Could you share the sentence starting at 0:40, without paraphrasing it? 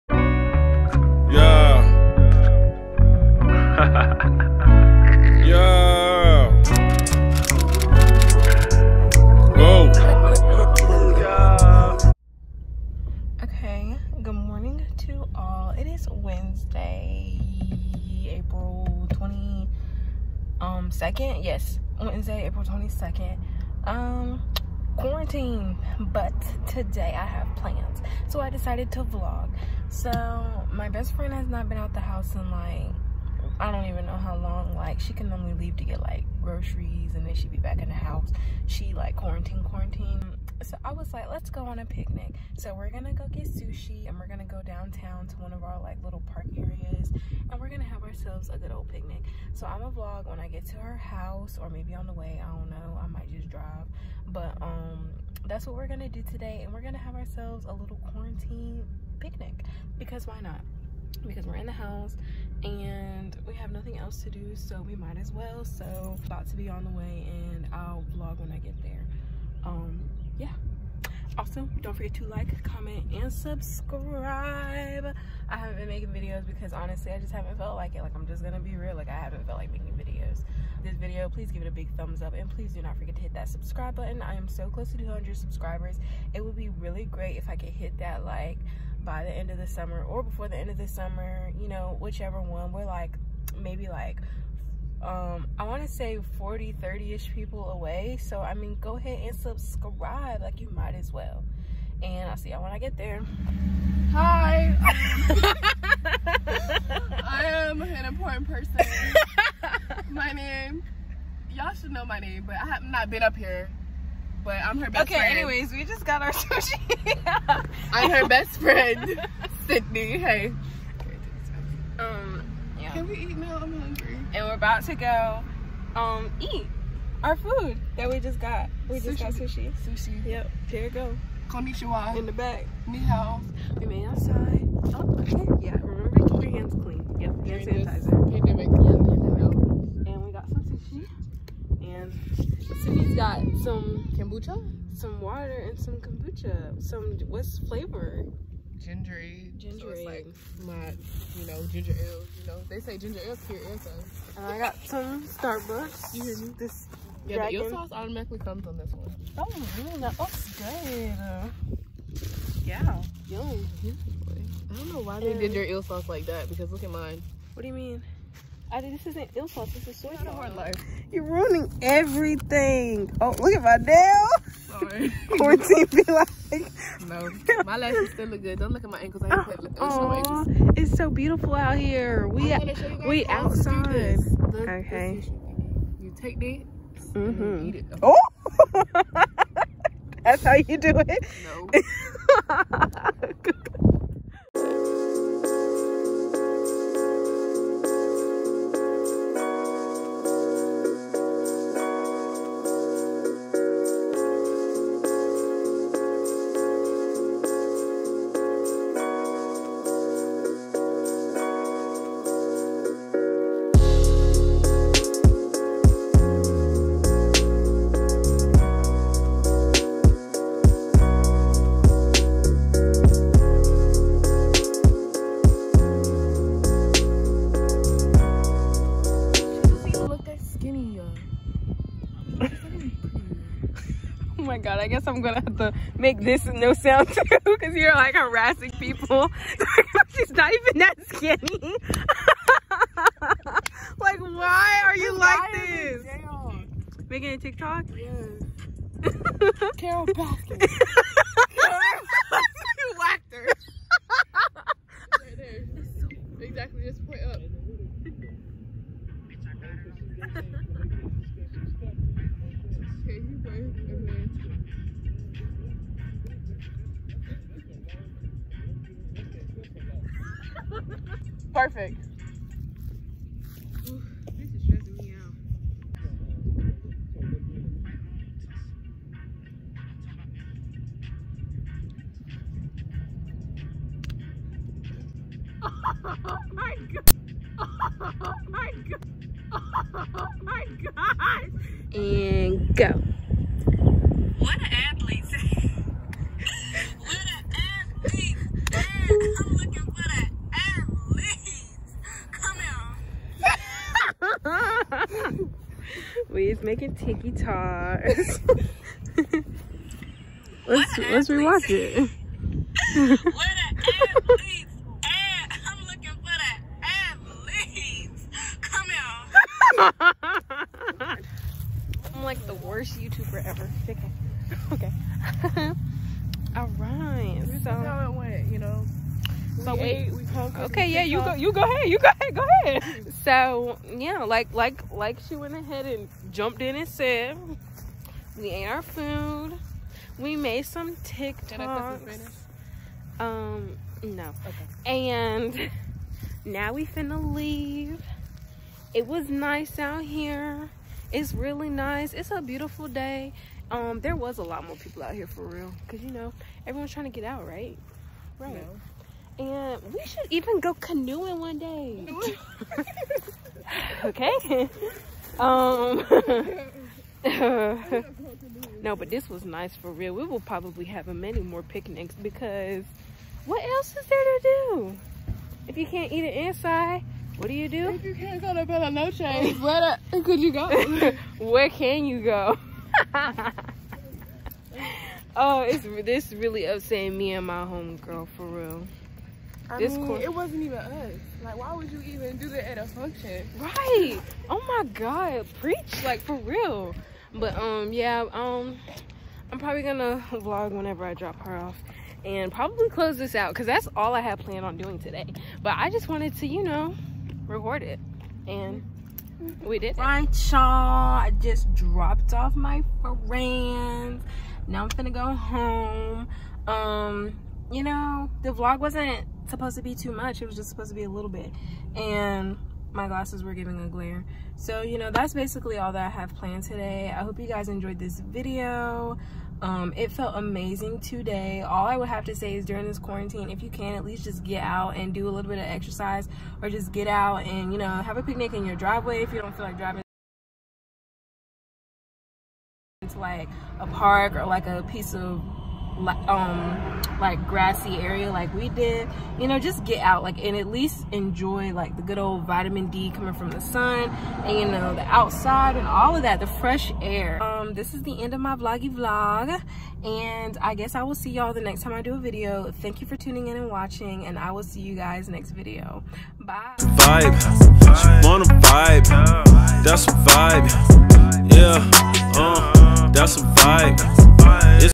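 So I was like, let's go on a picnic.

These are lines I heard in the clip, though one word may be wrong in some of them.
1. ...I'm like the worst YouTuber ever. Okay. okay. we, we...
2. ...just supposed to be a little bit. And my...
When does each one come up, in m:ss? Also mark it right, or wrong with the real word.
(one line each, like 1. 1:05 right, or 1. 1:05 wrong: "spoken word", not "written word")
1. 5:22 right
2. 7:00 right.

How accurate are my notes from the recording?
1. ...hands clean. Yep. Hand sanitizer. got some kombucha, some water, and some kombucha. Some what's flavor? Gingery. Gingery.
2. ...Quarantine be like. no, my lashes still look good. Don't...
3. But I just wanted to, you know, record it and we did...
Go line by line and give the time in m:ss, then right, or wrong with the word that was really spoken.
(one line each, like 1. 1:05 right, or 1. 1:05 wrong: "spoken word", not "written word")
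1. 2:16 right
2. 2:55 right
3. 6:45 right.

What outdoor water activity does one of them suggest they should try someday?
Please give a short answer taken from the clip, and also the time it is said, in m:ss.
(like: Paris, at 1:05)
Canoeing, at 6:00.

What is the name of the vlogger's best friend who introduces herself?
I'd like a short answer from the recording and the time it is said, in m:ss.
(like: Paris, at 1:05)
Sydnee, at 1:59.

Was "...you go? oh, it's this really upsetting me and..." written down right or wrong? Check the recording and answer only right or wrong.
right.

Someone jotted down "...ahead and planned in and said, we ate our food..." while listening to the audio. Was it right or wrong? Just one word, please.
wrong.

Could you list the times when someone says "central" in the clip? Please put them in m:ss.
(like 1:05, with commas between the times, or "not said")
not said.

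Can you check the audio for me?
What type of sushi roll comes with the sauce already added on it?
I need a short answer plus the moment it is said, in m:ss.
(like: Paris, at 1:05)
Dragon, at 2:37.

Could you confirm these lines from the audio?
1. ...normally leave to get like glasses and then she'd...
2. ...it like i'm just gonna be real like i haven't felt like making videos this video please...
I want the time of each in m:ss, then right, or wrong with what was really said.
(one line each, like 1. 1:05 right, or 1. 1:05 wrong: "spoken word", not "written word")
1. 0:35 wrong: "groceries", not "glasses"
2. 1:17 right.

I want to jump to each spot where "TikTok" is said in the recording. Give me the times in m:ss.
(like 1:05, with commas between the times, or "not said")
4:07, 5:40.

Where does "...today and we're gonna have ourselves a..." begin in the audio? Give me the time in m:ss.
0:56.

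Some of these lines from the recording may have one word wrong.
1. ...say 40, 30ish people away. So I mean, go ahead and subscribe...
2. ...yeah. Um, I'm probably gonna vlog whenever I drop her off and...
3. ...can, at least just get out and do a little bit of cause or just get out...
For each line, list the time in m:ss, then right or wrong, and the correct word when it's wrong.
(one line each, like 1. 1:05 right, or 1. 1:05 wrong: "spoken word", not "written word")
1. 1:35 right
2. 6:37 right
3. 7:13 wrong: "exercise", not "cause".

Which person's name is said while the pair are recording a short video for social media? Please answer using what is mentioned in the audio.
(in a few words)
Carole Baskin.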